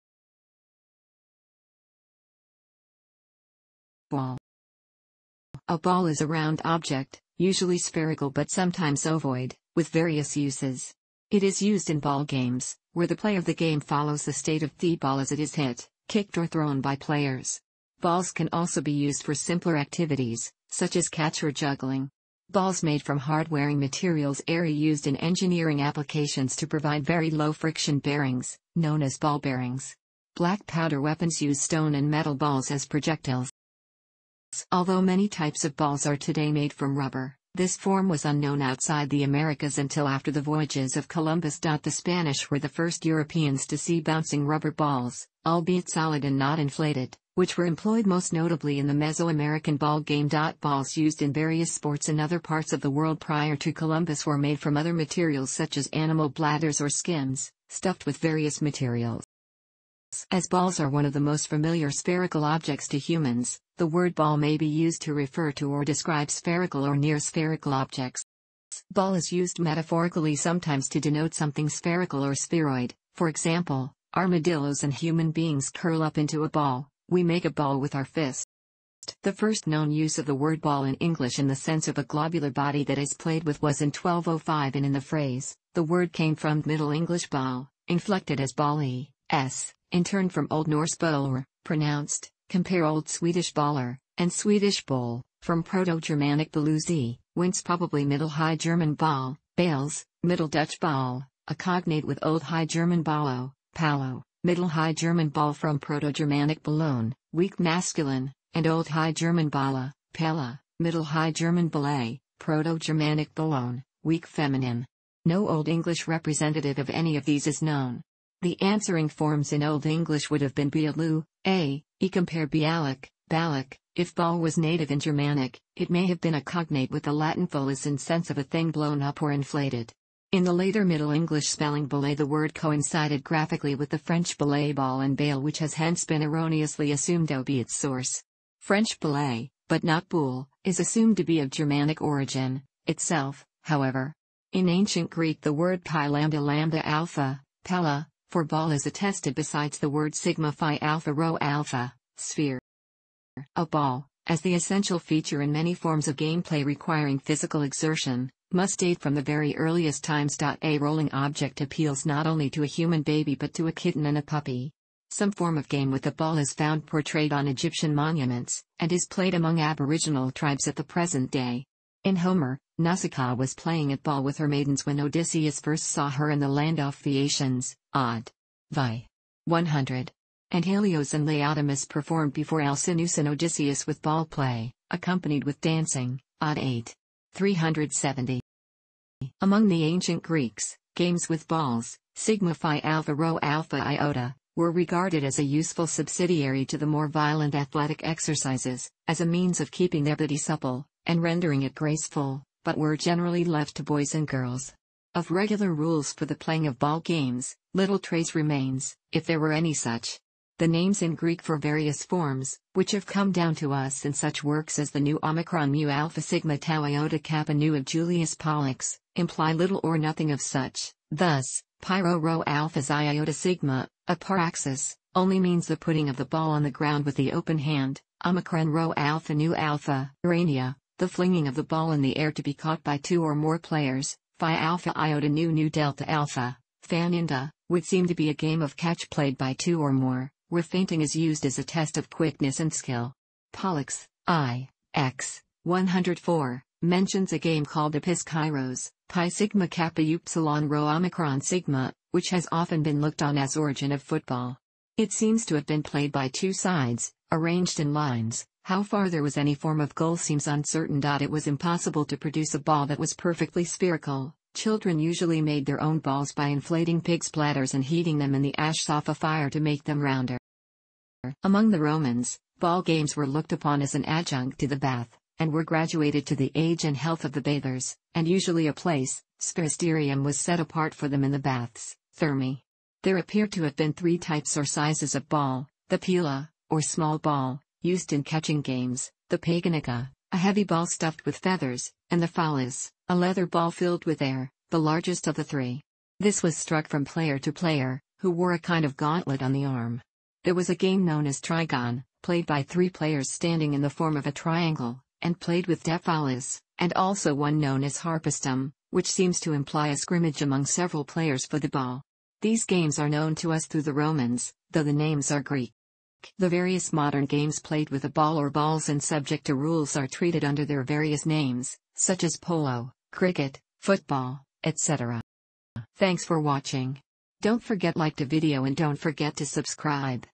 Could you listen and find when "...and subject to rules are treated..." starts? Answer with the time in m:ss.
5:18.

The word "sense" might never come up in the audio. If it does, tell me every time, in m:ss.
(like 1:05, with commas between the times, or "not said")
1:21, 2:07.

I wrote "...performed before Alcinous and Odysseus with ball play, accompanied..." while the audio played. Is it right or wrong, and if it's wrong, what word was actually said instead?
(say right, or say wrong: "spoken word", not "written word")
right.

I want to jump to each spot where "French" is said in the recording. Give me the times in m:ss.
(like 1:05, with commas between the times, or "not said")
2:13, 2:18.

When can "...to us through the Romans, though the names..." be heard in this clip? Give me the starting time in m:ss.
5:13.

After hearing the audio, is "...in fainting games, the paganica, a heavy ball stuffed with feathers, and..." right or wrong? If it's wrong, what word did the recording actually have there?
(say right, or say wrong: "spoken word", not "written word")
wrong: "catching", not "fainting".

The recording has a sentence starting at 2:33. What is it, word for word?
A ball, as the essential feature in many forms of gameplay requiring physical exertion, must date from the very earliest times.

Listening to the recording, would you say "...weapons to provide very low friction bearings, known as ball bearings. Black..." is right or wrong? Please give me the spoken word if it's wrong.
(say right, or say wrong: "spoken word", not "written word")
wrong: "applications", not "weapons".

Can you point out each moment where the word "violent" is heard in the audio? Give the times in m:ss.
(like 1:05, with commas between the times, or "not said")
3:17.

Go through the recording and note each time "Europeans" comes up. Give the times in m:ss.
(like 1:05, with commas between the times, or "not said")
0:43.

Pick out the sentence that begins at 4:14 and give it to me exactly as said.
It seems to have been played by two sides, arranged in lines.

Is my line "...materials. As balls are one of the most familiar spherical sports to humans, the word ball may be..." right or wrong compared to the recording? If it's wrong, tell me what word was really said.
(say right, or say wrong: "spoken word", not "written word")
wrong: "objects", not "sports".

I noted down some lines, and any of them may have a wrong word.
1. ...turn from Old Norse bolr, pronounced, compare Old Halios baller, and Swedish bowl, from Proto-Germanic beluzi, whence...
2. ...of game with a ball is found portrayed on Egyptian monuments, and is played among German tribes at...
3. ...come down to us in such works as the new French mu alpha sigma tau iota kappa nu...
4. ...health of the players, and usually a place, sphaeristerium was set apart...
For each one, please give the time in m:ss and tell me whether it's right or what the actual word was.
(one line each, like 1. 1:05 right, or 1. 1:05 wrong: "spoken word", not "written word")
1. 1:30 wrong: "Swedish", not "Halios"
2. 2:45 wrong: "Aboriginal", not "German"
3. 3:33 wrong: "Omicron", not "French"
4. 4:36 wrong: "bathers", not "players".